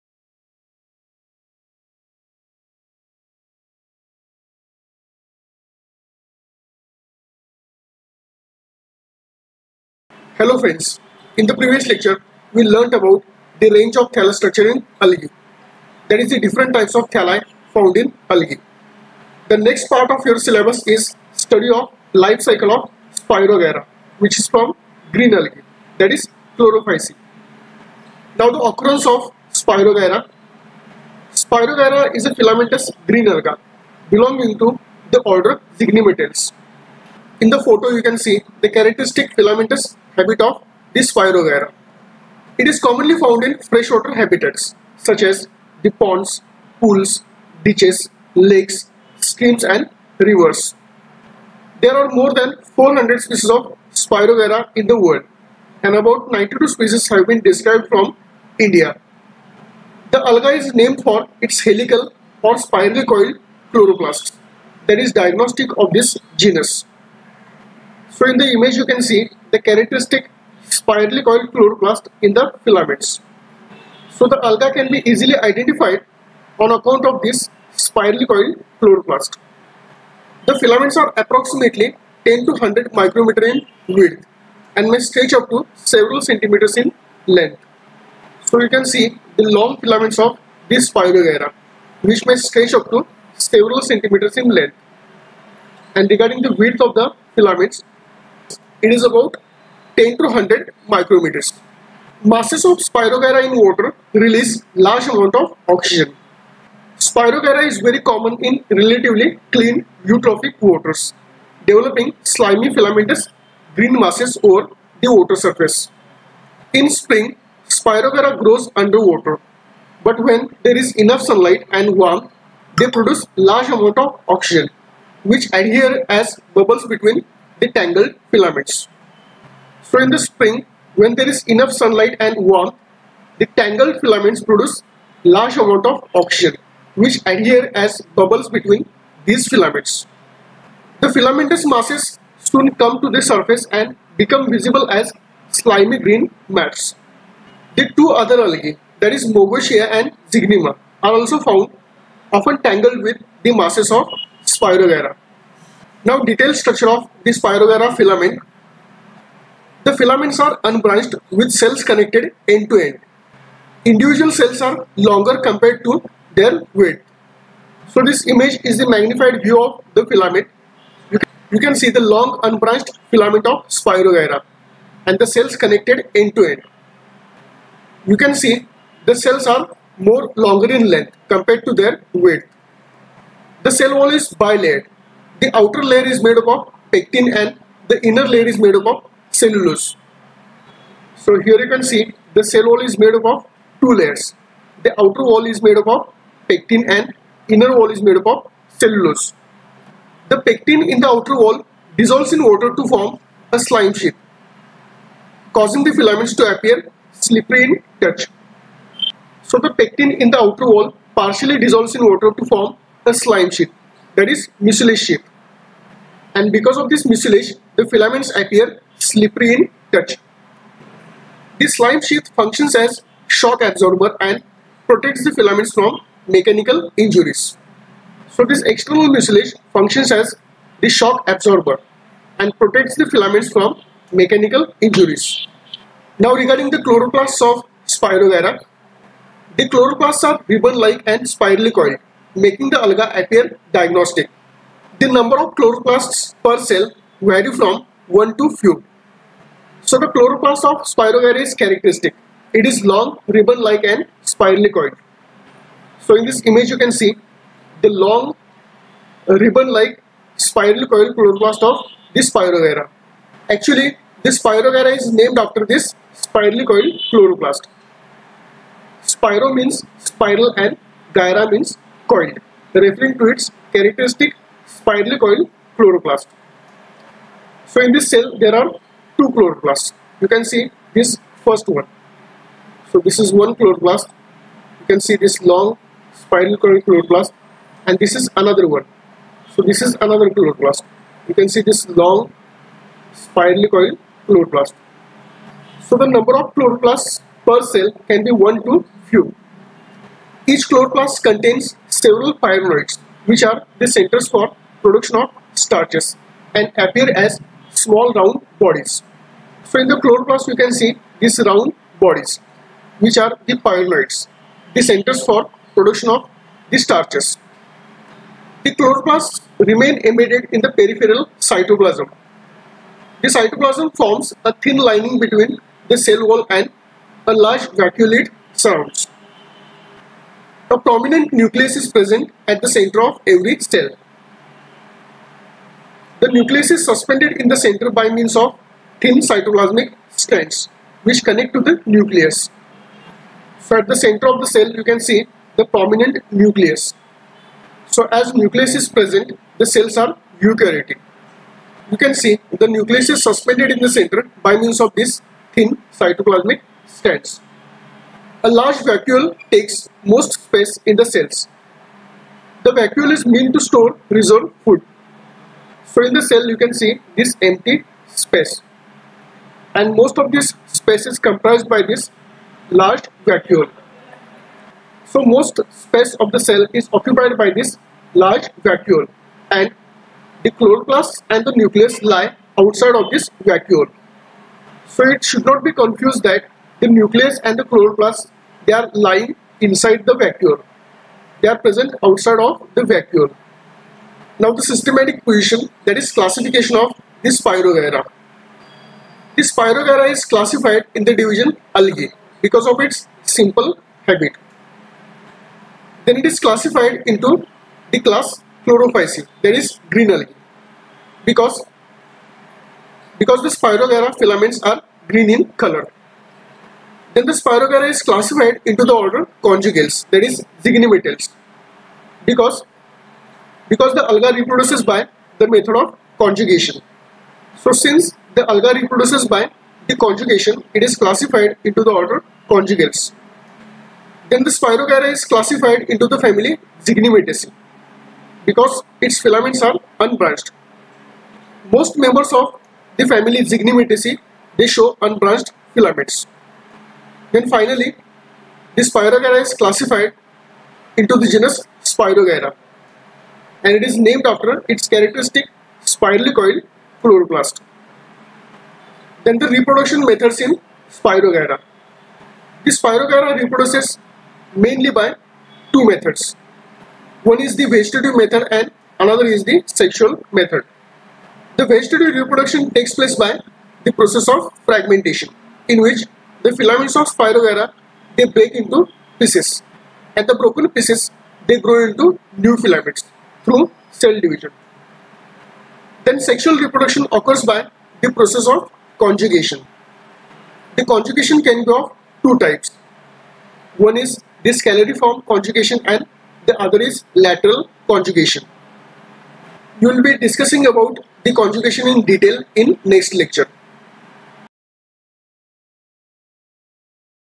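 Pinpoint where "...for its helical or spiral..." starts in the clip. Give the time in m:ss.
1:01.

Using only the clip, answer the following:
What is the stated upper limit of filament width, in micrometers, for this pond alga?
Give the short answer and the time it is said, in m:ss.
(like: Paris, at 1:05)
100 micrometers, at 1:40.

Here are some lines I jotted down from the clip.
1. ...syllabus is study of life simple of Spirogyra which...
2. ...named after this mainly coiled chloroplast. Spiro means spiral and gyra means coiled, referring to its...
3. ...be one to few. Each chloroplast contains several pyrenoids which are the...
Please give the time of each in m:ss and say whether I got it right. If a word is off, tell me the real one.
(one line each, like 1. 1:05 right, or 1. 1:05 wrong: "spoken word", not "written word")
1. 0:20 wrong: "cycle", not "simple"
2. 4:25 wrong: "spirally", not "mainly"
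3. 4:58 right.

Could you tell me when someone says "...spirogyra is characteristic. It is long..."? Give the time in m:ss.
4:10.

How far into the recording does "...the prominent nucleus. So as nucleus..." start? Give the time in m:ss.
5:45.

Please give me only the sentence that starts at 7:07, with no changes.
So since the alga reproduces by the conjugation, it is classified into the order conjugales.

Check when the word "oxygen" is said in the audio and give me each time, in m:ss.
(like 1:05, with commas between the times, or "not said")
1:45, 2:04, 2:16.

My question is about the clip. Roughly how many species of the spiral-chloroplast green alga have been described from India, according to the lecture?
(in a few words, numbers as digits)
92.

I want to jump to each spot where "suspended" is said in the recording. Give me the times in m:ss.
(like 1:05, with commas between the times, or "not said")
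5:36, 5:53.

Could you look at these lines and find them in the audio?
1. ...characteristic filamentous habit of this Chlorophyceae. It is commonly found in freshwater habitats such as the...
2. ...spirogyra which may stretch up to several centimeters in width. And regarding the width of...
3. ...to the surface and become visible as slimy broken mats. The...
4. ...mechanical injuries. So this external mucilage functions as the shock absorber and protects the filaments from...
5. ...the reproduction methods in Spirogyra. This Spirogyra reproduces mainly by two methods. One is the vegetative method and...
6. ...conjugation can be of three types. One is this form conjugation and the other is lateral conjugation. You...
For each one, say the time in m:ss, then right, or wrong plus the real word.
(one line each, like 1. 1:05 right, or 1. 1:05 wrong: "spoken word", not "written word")
1. 0:38 wrong: "Spirogyra", not "Chlorophyceae"
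2. 1:30 wrong: "length", not "width"
3. 2:23 wrong: "green", not "broken"
4. 3:46 right
5. 7:39 right
6. 8:10 wrong: "two", not "three".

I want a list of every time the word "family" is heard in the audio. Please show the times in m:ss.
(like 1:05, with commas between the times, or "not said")
7:16, 7:23.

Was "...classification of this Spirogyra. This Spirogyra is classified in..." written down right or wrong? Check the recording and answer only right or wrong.
right.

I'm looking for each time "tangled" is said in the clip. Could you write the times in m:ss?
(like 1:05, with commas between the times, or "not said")
2:07, 2:13, 2:32.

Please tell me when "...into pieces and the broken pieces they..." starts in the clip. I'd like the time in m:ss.
7:58.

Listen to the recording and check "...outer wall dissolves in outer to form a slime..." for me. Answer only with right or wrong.
wrong.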